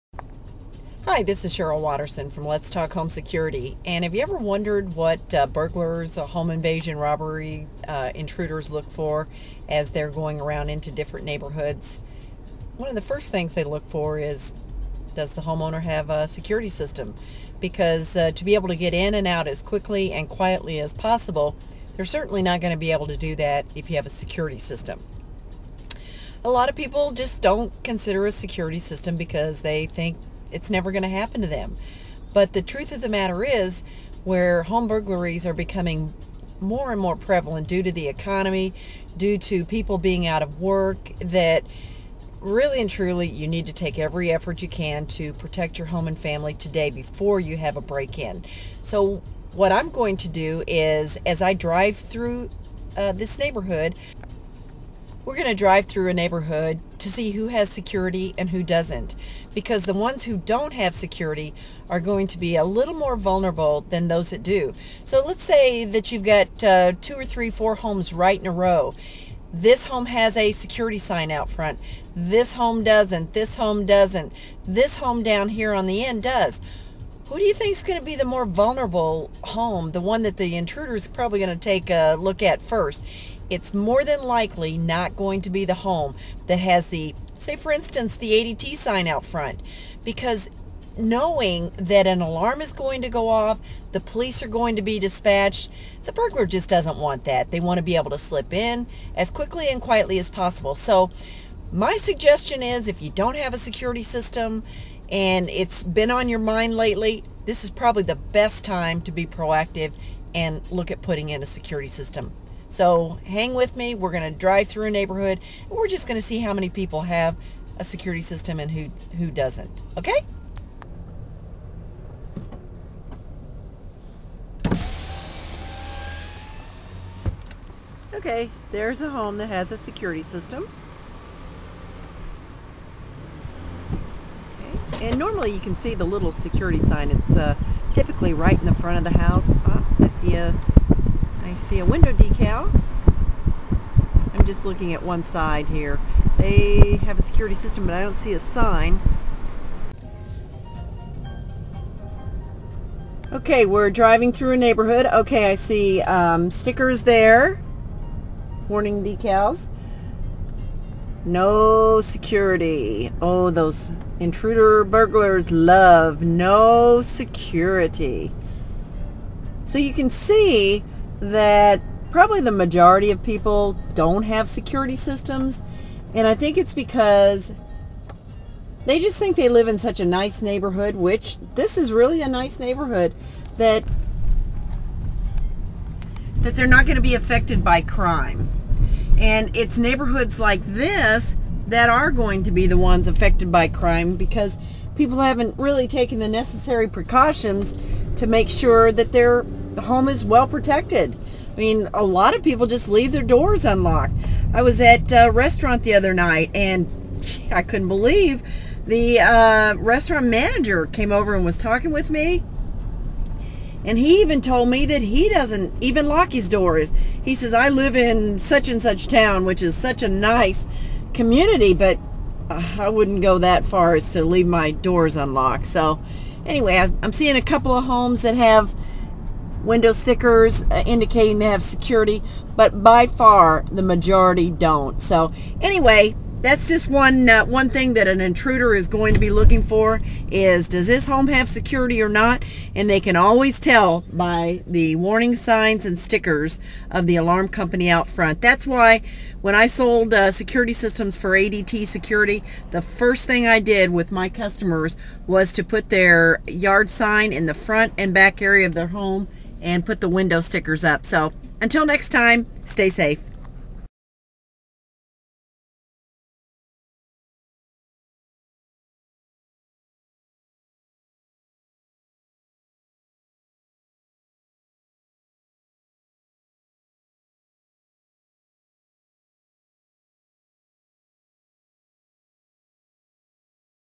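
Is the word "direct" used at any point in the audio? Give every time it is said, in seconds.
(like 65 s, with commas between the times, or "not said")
not said.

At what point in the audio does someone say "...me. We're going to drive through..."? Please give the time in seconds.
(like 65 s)
113 s.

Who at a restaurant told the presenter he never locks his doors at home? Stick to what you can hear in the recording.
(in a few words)
restaurant manager.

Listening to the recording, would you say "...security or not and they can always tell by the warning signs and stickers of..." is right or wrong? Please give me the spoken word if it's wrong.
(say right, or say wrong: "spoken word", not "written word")
right.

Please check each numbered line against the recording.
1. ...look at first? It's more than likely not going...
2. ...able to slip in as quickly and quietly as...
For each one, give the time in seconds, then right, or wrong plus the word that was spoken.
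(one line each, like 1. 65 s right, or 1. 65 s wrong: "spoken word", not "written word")
1. 82 s right
2. 97 s right.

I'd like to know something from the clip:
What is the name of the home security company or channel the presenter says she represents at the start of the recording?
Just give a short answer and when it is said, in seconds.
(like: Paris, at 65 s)
Let's Talk Home Security, at 2 s.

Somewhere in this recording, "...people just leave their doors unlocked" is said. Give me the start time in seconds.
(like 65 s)
202 s.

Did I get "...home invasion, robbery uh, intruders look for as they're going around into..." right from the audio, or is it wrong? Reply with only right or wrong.
right.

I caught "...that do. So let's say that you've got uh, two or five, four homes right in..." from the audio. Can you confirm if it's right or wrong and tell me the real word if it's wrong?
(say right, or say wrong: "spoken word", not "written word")
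wrong: "three", not "five".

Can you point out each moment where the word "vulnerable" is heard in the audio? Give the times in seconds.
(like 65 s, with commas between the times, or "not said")
63 s, 78 s.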